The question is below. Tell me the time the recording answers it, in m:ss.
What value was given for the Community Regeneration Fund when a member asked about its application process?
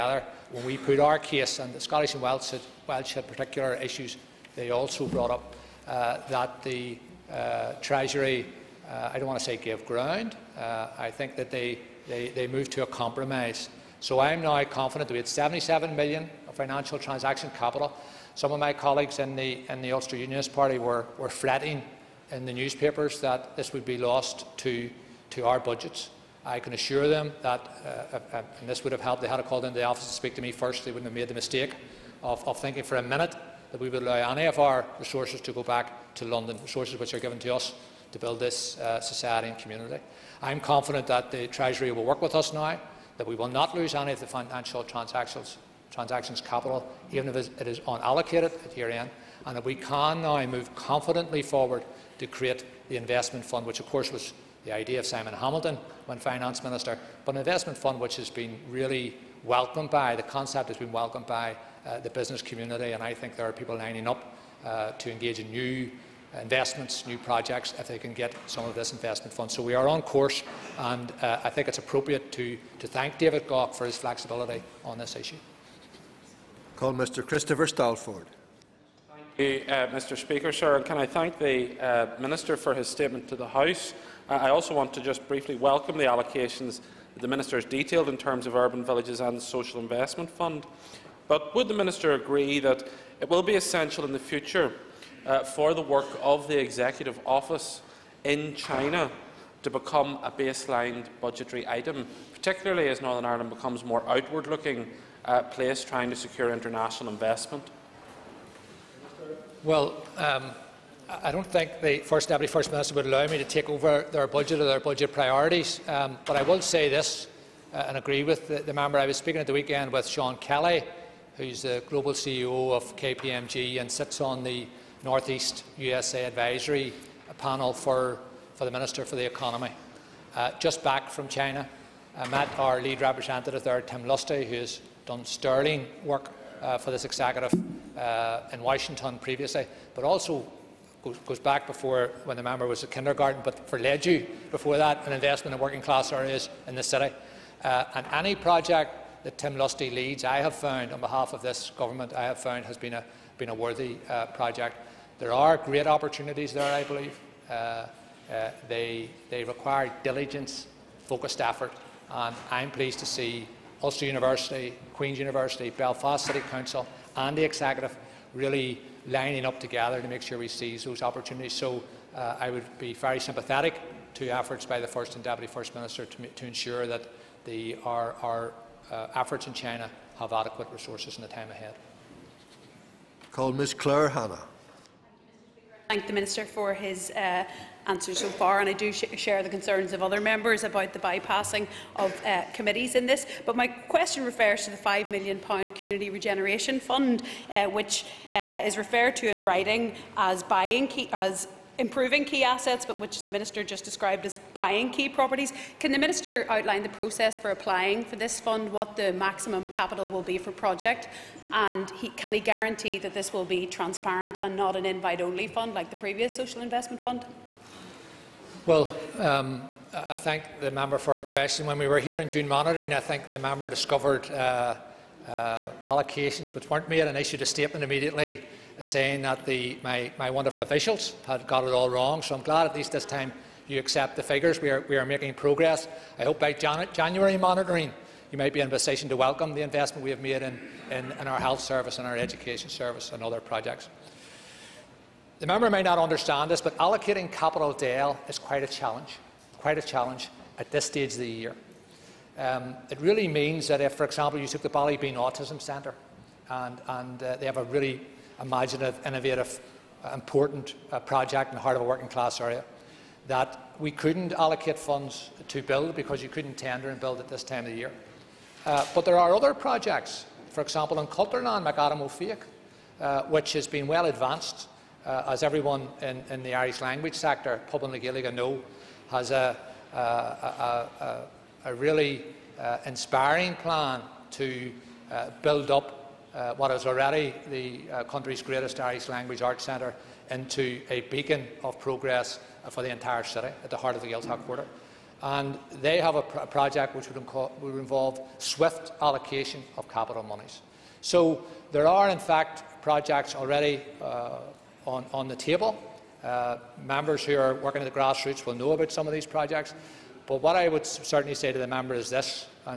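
3:14.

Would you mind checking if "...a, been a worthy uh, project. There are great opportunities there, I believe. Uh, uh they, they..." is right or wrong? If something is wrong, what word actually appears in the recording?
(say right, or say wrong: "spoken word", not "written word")
right.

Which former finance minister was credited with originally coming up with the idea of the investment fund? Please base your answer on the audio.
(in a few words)
Simon Hamilton.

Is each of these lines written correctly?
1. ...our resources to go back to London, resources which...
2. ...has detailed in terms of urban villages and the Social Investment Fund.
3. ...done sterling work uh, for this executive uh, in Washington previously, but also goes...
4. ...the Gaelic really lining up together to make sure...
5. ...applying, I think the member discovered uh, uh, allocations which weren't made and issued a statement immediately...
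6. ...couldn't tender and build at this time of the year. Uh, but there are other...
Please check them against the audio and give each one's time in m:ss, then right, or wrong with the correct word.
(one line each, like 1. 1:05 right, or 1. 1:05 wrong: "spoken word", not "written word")
1. 0:34 right
2. 1:27 right
3. 2:15 right
4. 2:47 wrong: "Executive", not "Gaelic"
5. 3:42 wrong: "monitoring", not "applying"
6. 4:26 right.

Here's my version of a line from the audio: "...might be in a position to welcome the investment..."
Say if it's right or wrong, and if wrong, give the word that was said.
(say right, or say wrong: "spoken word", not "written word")
right.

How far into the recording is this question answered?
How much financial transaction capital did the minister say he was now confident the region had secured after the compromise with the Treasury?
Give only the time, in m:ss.
0:15.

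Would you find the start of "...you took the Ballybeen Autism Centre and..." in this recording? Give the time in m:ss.
4:14.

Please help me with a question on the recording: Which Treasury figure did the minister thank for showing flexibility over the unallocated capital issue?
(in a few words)
David Gauke.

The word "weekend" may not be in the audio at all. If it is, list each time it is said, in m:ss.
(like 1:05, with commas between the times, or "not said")
1:59.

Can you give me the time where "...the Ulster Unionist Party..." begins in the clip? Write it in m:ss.
0:19.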